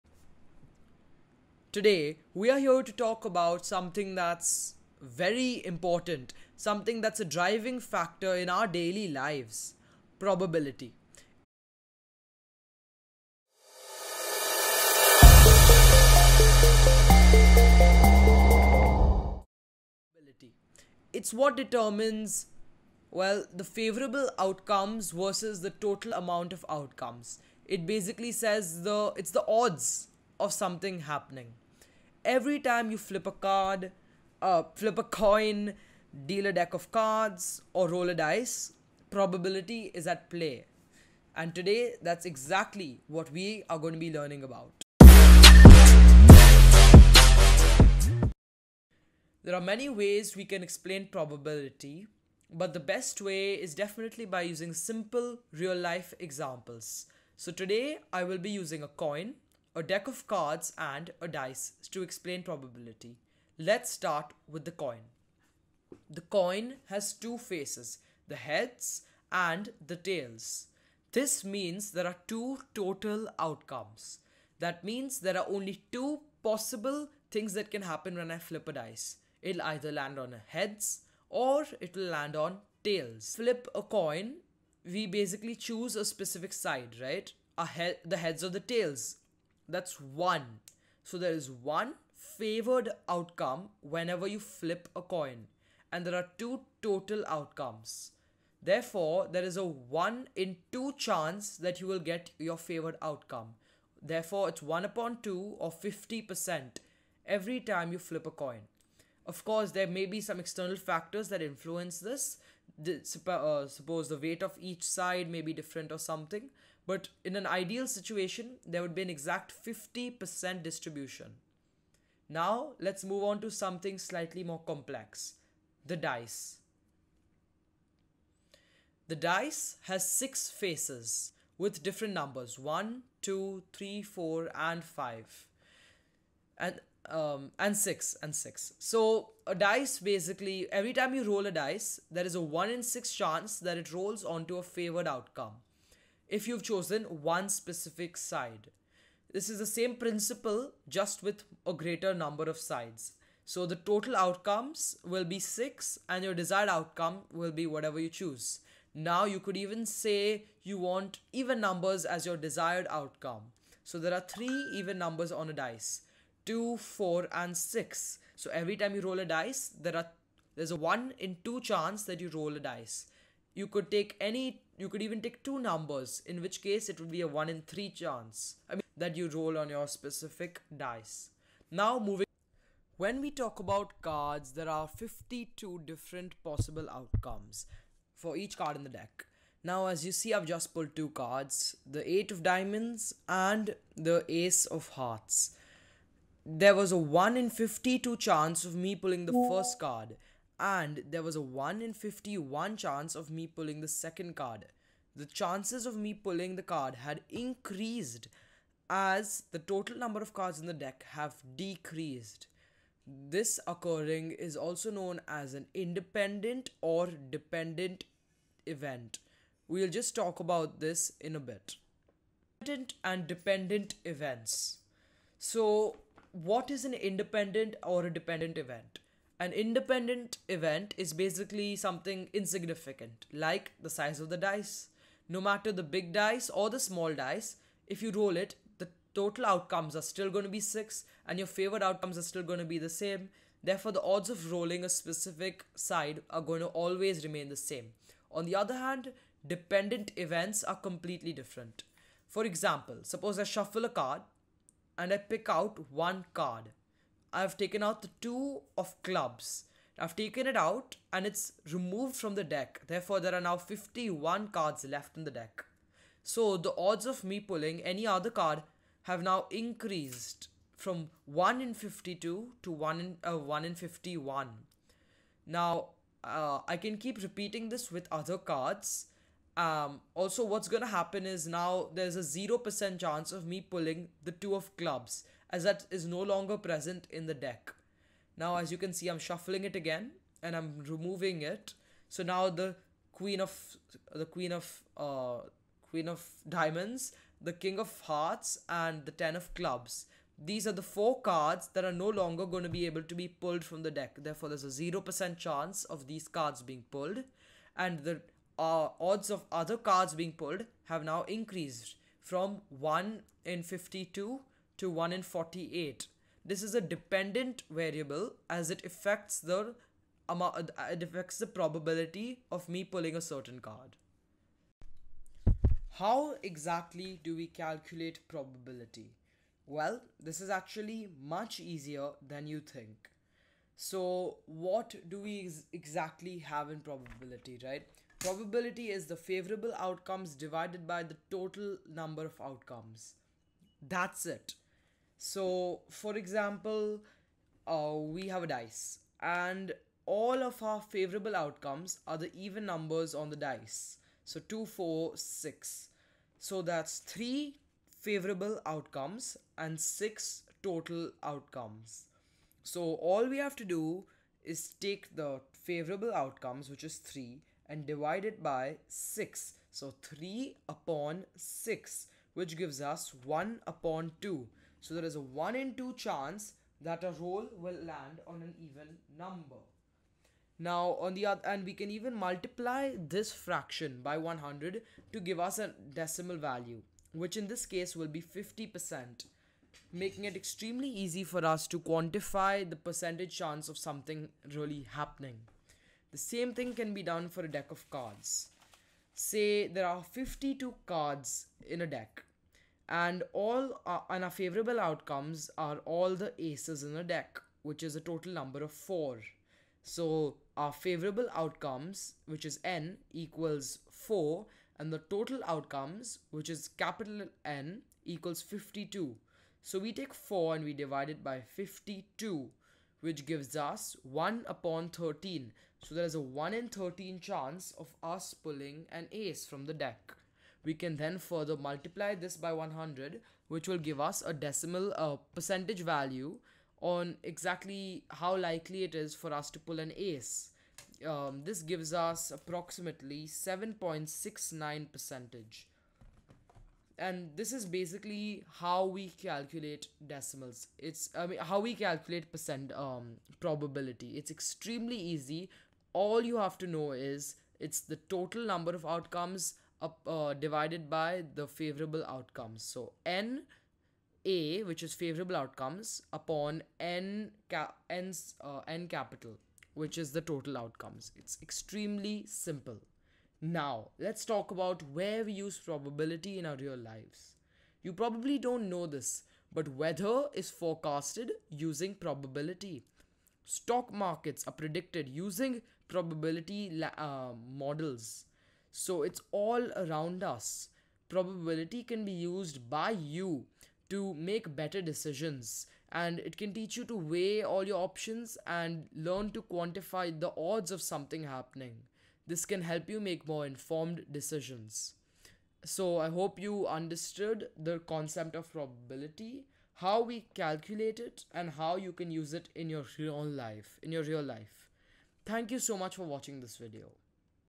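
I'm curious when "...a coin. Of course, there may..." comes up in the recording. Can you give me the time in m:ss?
1:48.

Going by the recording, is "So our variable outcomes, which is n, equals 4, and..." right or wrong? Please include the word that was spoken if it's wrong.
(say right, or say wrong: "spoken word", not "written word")
wrong: "favorable", not "variable".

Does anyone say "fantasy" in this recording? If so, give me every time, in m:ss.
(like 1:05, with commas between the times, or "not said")
not said.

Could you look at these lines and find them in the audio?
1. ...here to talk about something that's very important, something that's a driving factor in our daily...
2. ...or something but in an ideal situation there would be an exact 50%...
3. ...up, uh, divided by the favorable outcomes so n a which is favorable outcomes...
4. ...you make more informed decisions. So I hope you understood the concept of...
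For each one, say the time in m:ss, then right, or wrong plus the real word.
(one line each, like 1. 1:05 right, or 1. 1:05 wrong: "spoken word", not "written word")
1. 0:02 right
2. 1:55 right
3. 7:39 right
4. 8:22 right.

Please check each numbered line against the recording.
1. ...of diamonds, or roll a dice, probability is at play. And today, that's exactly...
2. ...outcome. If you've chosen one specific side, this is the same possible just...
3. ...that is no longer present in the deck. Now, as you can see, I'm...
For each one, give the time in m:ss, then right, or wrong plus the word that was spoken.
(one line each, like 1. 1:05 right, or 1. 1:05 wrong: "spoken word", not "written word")
1. 0:36 wrong: "cards", not "diamonds"
2. 2:25 wrong: "principle", not "possible"
3. 4:45 right.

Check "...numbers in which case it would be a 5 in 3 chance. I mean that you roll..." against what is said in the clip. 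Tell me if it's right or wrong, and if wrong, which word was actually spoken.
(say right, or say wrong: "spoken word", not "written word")
wrong: "1", not "5".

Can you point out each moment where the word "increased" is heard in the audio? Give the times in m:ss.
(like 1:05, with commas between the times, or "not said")
3:27, 4:29, 5:11.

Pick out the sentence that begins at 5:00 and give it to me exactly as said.
These are the four cards that are no longer going to be able to be pulled from the deck.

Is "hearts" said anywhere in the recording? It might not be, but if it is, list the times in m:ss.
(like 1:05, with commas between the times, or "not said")
3:14, 4:58.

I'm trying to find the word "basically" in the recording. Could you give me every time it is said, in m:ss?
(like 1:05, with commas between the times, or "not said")
0:27, 1:25, 2:19, 3:51, 7:27.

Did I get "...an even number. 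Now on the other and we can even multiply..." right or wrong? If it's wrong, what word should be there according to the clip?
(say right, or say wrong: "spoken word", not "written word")
right.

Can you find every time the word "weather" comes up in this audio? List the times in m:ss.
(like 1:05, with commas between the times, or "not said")
7:59.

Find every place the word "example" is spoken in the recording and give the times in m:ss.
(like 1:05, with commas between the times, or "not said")
0:56, 4:12, 5:46.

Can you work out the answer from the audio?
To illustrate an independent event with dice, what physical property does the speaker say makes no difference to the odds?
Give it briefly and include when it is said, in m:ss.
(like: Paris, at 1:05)
size of the dice, at 3:53.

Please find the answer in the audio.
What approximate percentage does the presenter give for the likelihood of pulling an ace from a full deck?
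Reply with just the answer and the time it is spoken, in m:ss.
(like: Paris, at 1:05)
7.69%, at 7:23.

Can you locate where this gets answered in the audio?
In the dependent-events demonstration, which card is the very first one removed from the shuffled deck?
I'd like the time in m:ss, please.
4:18.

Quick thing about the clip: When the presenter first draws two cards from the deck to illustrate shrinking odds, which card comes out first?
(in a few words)
Eight of Diamonds.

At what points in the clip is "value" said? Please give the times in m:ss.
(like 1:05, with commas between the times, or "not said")
6:26, 7:15.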